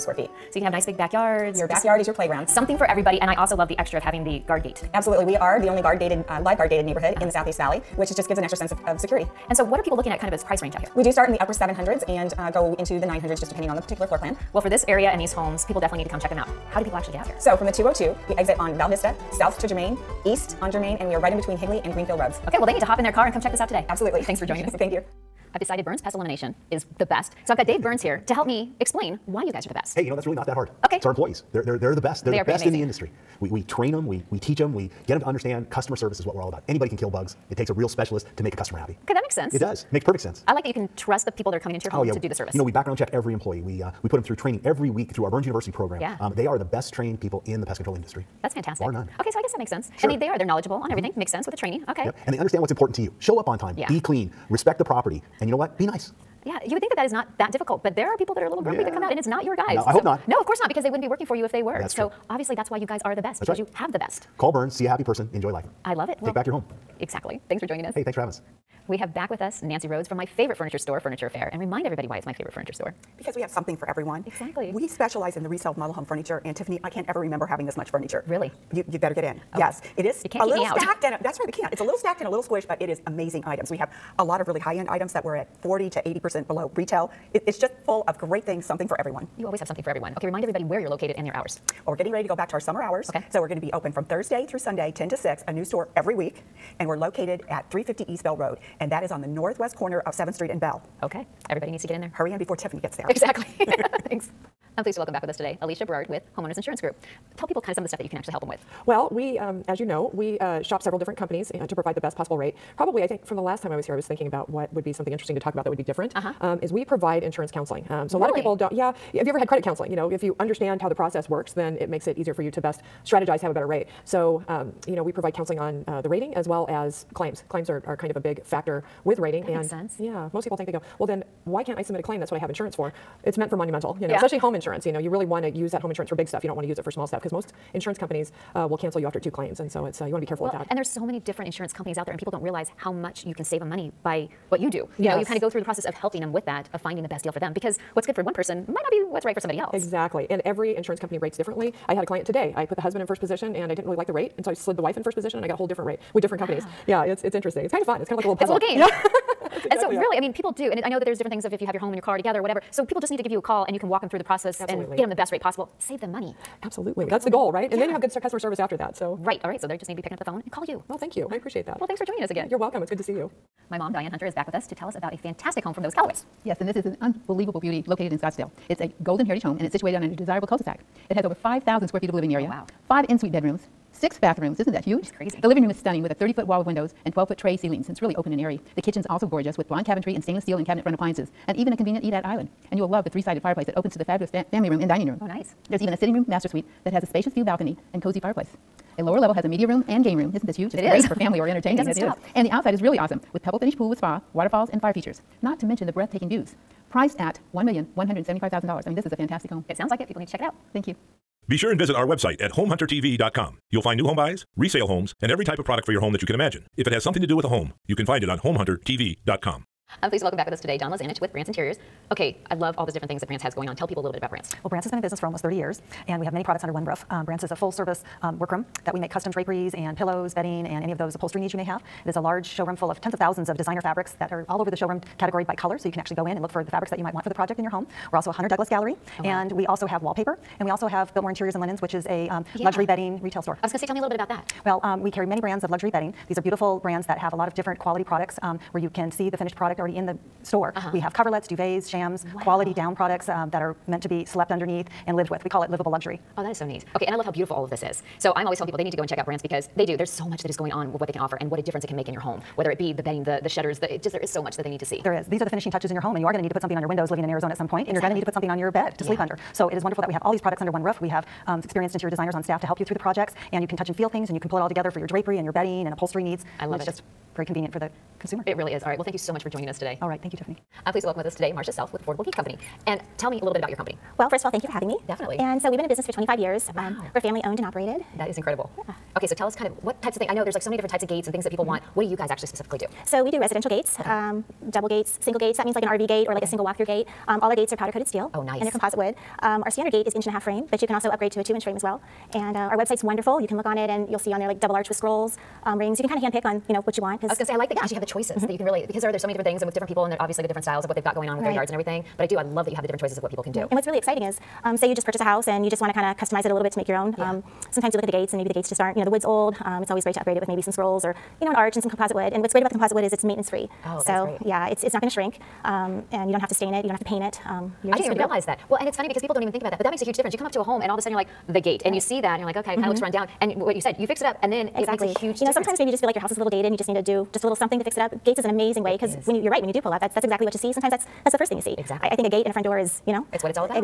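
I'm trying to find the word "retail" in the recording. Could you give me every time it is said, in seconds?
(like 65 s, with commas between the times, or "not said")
86 s, 243 s.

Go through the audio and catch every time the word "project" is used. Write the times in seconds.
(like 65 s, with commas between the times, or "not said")
237 s, 272 s.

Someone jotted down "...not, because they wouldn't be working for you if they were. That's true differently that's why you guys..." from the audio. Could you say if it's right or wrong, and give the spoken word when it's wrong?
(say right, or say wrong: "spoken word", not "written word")
wrong: "obviously", not "differently".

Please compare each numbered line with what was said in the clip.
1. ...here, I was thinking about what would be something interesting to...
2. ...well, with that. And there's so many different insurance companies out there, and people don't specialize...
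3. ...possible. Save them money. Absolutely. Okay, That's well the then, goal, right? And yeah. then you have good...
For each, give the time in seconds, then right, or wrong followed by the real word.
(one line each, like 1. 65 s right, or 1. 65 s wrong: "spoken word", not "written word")
1. 113 s right
2. 140 s wrong: "realize", not "specialize"
3. 165 s right.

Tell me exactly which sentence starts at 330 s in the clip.
You come up to a home and all of a sudden you're like, the gate and right.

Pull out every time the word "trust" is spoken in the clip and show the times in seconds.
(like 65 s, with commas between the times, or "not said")
40 s.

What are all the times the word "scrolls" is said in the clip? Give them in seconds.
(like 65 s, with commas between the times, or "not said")
304 s, 320 s.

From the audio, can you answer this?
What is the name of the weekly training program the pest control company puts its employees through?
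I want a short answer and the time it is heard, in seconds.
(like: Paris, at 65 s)
Burns University, at 45 s.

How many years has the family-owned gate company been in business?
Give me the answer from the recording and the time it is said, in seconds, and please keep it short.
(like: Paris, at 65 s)
25 years, at 286 s.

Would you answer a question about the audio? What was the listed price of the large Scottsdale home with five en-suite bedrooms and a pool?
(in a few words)
$1,175,000.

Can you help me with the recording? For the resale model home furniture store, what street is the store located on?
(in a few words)
East Bell Road.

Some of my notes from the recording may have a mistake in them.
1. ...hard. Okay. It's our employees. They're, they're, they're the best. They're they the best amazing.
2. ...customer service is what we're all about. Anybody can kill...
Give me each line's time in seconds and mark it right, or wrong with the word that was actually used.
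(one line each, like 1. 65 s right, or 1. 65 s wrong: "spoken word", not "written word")
1. 30 s right
2. 35 s right.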